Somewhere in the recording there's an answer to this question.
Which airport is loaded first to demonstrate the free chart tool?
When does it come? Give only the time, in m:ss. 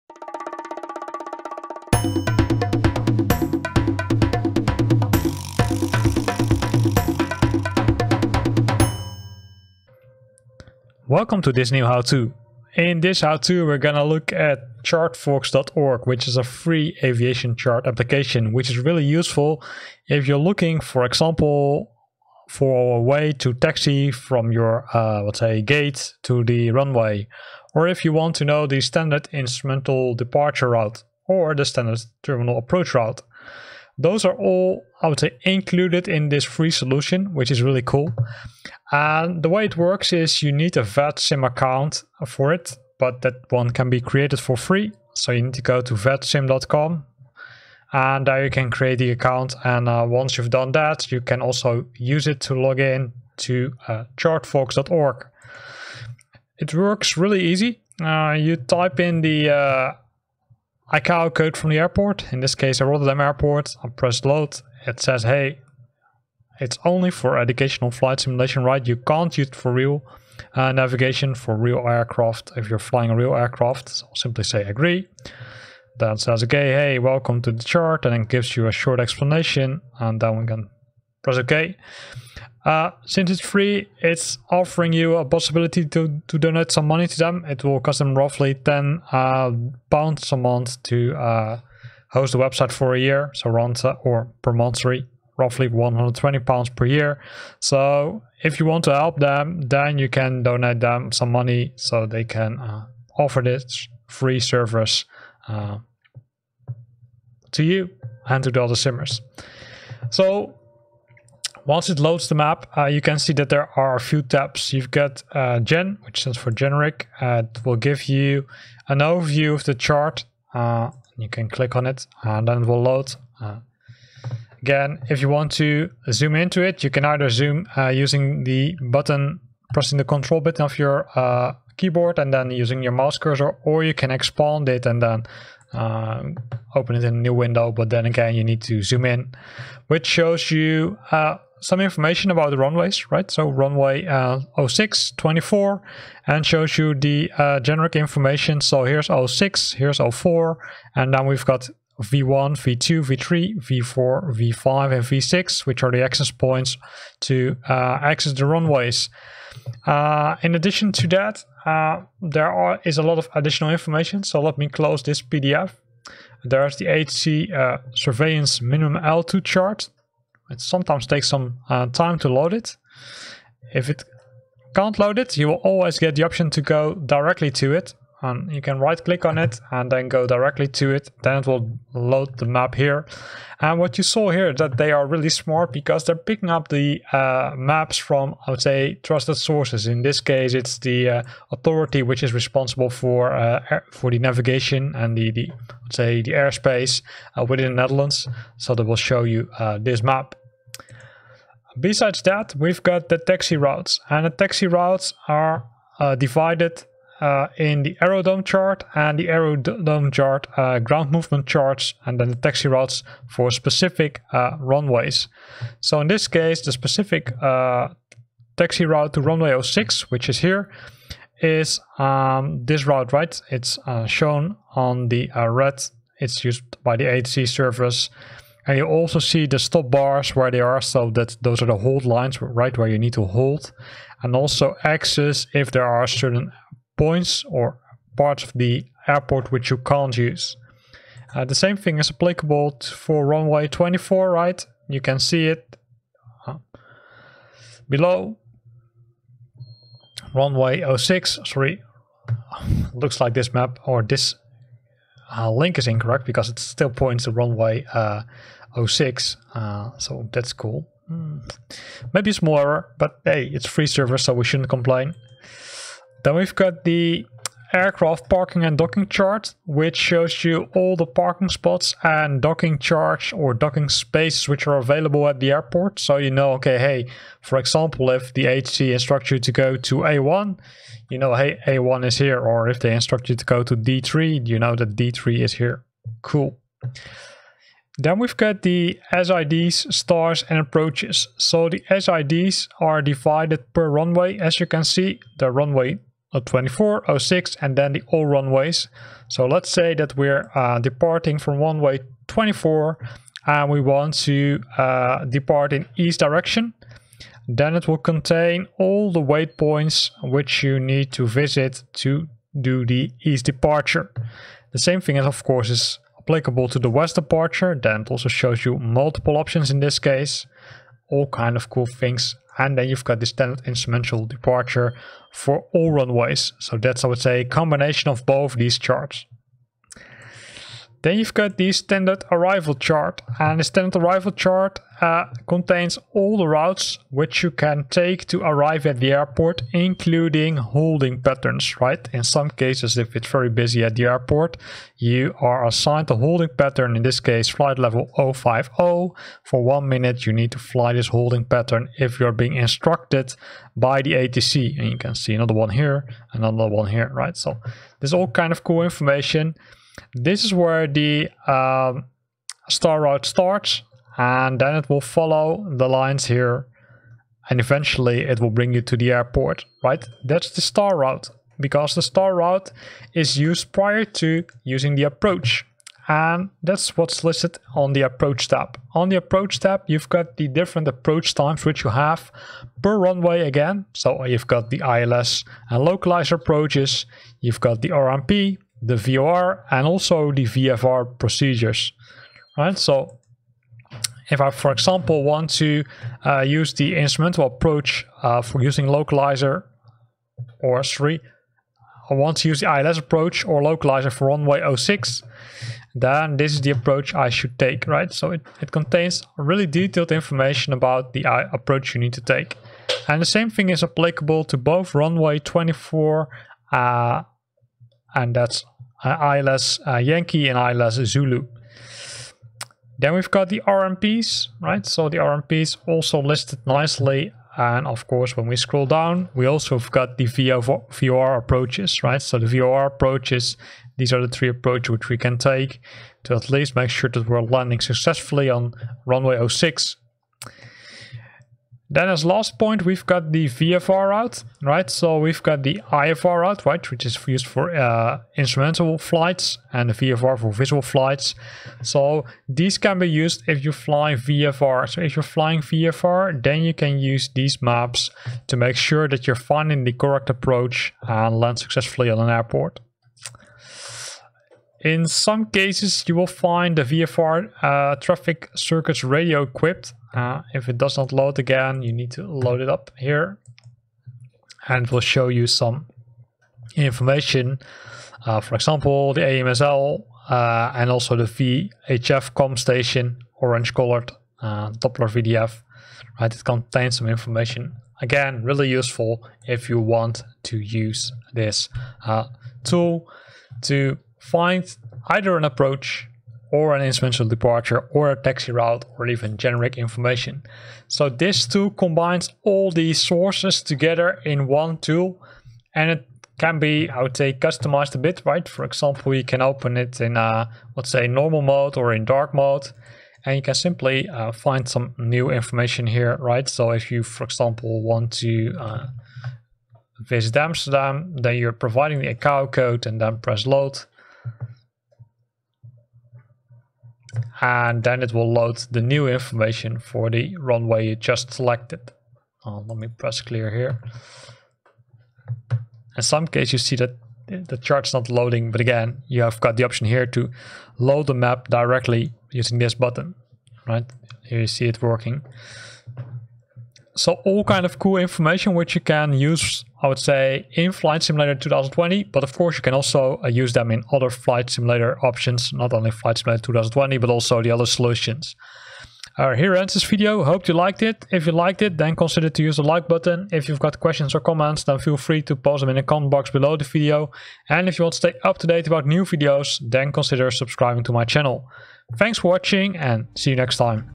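1:02.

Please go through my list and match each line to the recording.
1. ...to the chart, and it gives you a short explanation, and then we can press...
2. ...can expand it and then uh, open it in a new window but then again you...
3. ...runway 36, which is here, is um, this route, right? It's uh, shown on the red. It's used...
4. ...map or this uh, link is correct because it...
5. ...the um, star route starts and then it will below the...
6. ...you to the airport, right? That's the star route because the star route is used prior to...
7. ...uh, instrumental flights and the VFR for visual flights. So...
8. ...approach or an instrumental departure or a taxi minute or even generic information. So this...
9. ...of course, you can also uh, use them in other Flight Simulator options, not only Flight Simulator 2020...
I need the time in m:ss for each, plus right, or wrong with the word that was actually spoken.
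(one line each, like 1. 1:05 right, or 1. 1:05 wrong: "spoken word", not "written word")
1. 1:17 right
2. 2:13 right
3. 3:39 wrong: "06", not "36"
4. 4:13 wrong: "incorrect", not "correct"
5. 6:00 wrong: "follow", not "below"
6. 6:08 right
7. 7:27 right
8. 8:15 wrong: "route", not "minute"
9. 9:12 right.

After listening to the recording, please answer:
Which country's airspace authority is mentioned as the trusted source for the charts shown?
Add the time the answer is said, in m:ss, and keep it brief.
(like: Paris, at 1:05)
Netherlands, at 3:17.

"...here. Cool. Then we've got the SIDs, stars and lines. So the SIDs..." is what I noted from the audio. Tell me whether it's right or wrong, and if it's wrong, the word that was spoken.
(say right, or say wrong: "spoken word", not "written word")
wrong: "approaches", not "lines".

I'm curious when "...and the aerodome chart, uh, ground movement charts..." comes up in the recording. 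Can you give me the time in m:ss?
3:28.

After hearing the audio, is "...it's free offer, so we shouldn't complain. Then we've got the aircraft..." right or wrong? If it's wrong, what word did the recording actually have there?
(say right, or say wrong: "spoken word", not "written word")
wrong: "server", not "offer".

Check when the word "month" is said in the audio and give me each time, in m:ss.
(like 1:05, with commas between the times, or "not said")
1:30, 1:34.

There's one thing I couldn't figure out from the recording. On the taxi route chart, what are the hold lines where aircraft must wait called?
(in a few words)
Stop bars.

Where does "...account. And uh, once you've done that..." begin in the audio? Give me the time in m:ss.
0:49.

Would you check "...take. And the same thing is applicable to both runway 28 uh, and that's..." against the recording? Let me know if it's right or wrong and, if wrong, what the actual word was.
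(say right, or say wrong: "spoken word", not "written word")
wrong: "24", not "28".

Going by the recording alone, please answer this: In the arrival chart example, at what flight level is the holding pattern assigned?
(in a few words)
Flight level 050.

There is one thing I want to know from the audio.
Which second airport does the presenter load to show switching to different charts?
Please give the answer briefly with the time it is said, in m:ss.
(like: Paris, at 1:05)
Amsterdam, at 8:40.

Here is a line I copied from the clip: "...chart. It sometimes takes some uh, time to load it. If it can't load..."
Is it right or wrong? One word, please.
right.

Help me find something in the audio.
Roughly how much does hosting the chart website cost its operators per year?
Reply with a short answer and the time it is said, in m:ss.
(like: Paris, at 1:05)
120 pounds, at 1:35.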